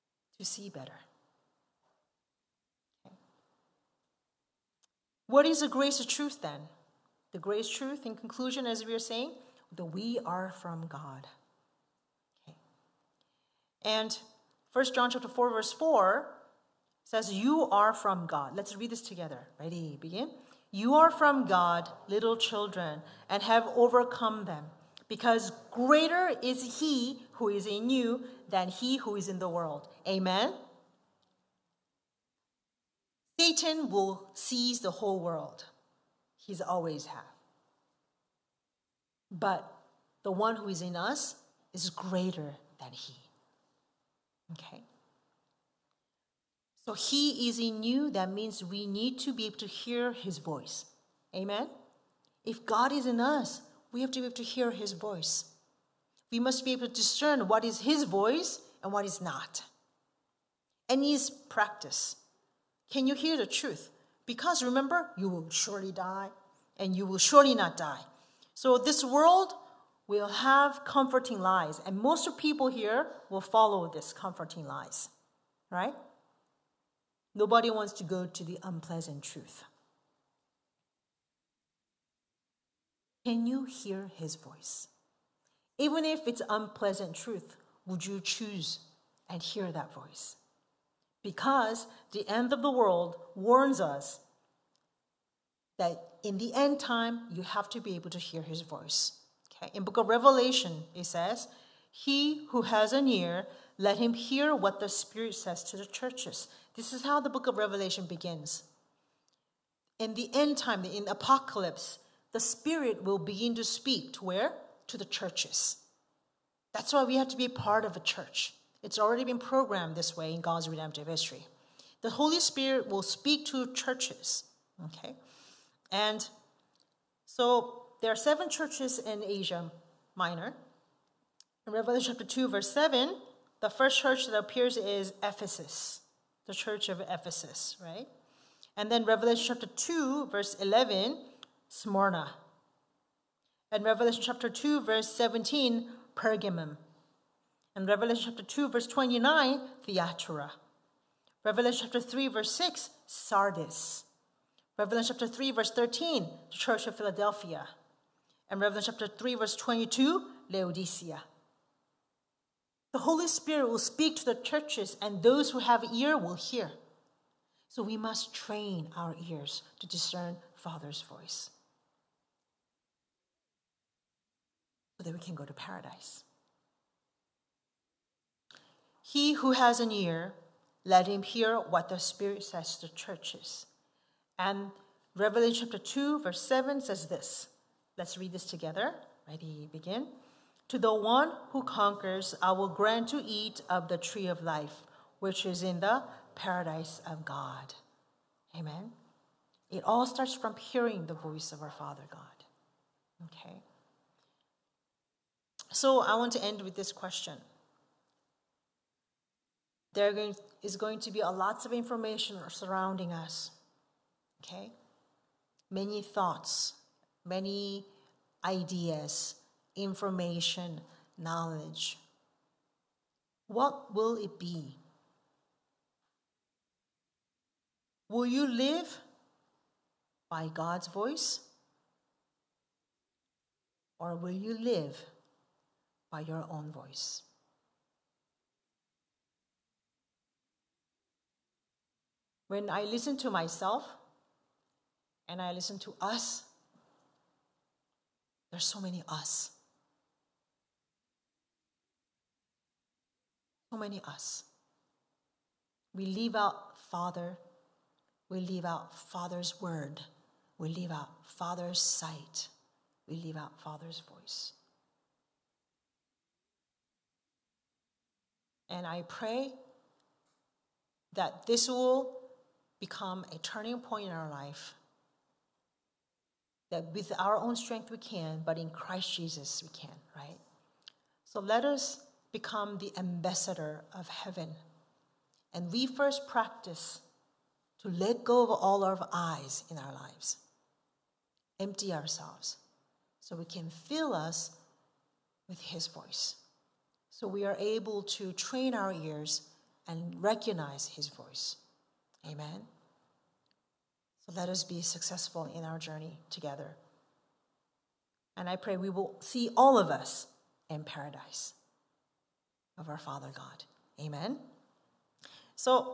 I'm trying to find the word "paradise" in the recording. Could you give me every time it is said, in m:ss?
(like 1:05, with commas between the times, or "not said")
2:55, 3:16, 5:10.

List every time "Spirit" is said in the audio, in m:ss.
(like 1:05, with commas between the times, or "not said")
1:44, 1:52, 2:02, 2:43, 3:01.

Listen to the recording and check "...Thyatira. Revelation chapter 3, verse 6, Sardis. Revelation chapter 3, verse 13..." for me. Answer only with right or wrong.
right.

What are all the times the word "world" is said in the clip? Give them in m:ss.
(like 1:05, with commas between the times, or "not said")
0:29, 0:35, 1:09, 1:32.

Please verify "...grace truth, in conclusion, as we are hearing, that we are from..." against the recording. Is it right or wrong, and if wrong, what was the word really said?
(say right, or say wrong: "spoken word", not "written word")
wrong: "saying", not "hearing".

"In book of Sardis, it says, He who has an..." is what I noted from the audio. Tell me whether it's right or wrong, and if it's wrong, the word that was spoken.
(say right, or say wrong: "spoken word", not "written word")
wrong: "Revelation", not "Sardis".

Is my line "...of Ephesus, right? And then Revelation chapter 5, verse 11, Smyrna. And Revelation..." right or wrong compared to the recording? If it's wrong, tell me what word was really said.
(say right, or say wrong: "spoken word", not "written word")
wrong: "2", not "5".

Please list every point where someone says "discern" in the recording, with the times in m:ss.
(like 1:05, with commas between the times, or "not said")
0:56, 2:49.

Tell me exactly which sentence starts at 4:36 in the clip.
That with our own strength we can, but in Christ Jesus we can, right?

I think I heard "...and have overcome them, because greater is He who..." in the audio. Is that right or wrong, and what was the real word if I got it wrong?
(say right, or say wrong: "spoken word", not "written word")
right.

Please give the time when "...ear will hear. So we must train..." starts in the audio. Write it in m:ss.
2:45.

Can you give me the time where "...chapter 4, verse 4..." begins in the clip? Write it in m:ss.
0:15.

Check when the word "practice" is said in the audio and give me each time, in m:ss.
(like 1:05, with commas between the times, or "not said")
1:01, 4:46.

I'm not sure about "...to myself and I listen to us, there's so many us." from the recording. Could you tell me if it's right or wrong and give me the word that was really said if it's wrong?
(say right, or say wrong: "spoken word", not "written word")
right.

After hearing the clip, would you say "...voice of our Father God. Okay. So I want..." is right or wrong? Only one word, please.
right.